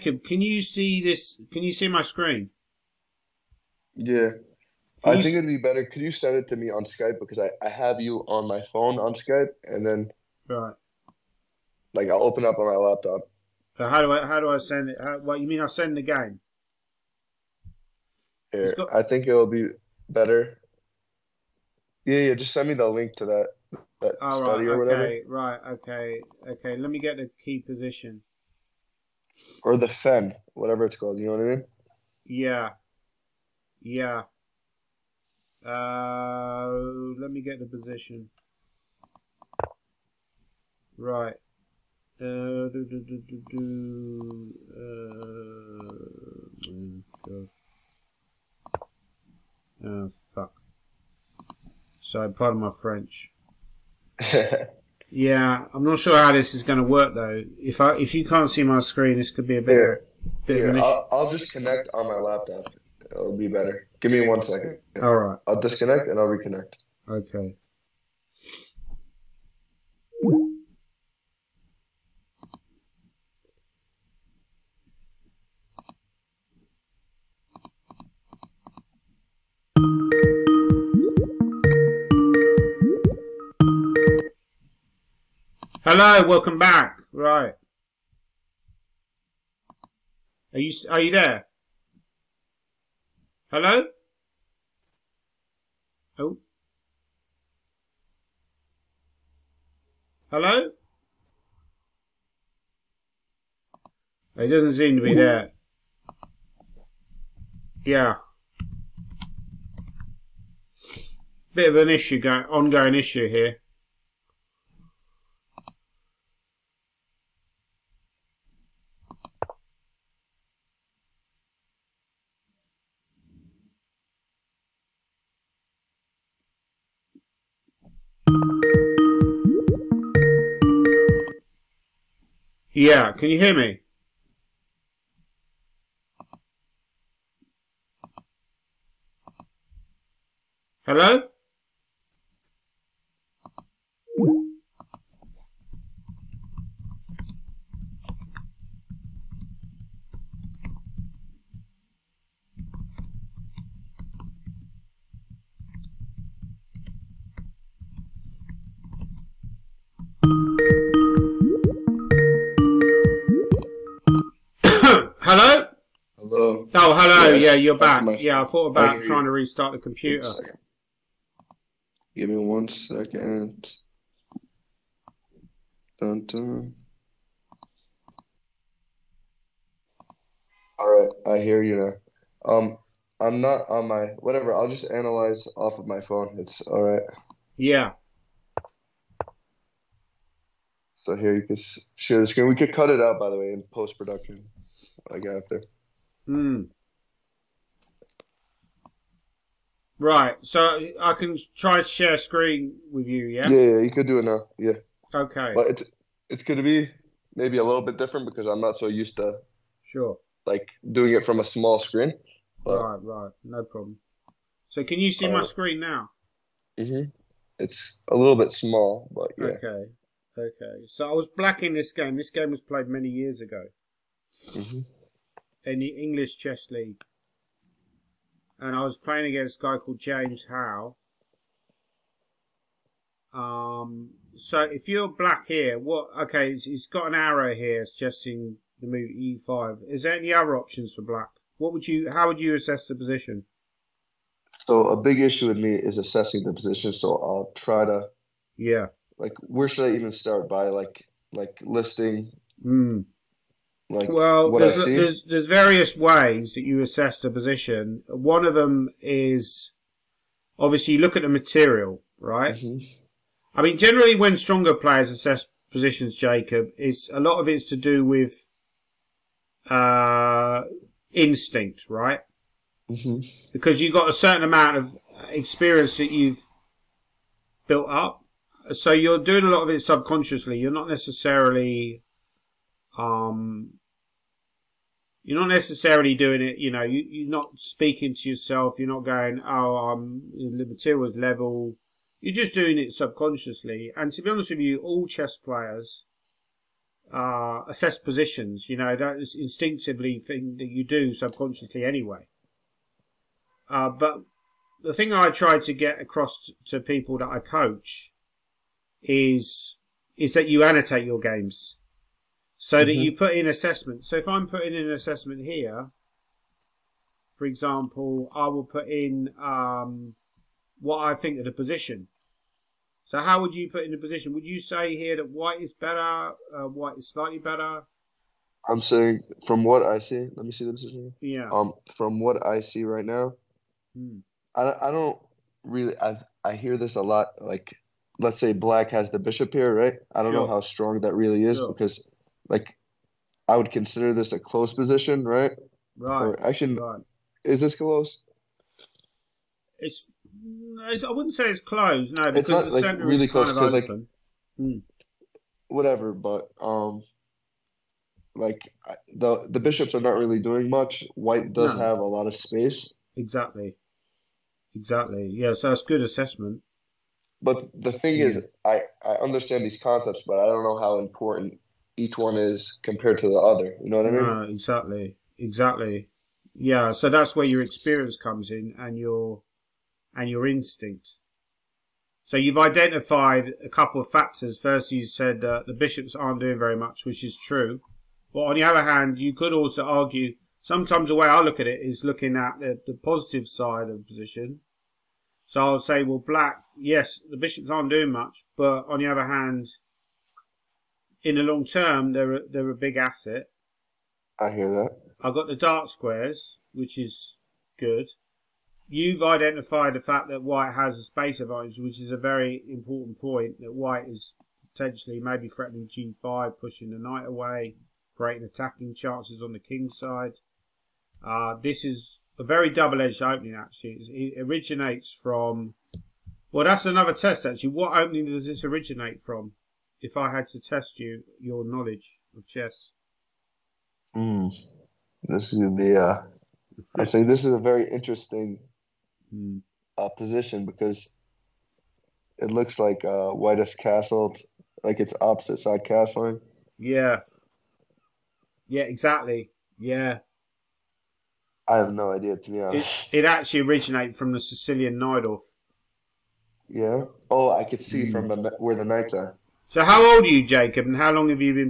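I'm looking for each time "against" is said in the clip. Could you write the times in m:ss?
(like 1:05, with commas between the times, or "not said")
3:49.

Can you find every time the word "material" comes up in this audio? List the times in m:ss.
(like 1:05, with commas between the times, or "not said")
4:21, 4:50.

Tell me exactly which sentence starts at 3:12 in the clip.
We could cut it out, by the way, in post production.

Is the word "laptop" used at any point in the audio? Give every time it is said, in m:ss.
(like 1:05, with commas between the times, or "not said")
0:12, 1:02.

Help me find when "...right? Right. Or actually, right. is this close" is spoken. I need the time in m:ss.
5:45.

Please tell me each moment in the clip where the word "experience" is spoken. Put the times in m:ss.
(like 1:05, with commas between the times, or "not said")
4:35, 6:17.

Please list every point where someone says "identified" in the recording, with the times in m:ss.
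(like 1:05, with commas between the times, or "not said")
6:22, 6:49.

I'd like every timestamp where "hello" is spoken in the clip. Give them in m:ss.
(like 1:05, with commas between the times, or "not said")
1:25, 1:33, 1:40, 2:20, 2:46.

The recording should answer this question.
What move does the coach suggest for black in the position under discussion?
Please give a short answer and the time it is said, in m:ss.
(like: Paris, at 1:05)
e5, at 3:59.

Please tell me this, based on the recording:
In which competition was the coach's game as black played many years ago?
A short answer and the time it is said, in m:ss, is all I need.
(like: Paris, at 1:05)
English Chess League, at 3:45.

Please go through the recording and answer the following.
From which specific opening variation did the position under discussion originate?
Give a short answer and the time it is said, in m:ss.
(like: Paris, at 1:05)
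Sicilian Najdorf, at 7:34.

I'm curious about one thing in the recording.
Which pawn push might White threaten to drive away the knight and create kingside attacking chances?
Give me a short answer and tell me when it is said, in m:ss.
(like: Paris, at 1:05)
G5, at 6:55.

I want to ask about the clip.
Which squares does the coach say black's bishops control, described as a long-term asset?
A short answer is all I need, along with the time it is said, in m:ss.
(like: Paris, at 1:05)
The dark squares, at 6:45.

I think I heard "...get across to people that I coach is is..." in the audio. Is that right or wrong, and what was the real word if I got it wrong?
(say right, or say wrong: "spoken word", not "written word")
right.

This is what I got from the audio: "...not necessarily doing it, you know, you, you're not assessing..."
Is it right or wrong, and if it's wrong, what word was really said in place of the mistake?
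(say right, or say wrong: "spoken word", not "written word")
wrong: "speaking", not "assessing".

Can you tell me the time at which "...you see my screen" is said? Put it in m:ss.
0:01.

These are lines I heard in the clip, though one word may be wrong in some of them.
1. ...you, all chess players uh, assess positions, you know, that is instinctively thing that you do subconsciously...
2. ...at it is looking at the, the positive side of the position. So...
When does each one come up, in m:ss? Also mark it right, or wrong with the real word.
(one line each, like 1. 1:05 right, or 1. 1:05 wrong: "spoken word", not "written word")
1. 4:54 right
2. 6:31 right.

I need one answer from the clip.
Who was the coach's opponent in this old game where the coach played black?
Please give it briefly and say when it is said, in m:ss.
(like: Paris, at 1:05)
James Howell, at 3:49.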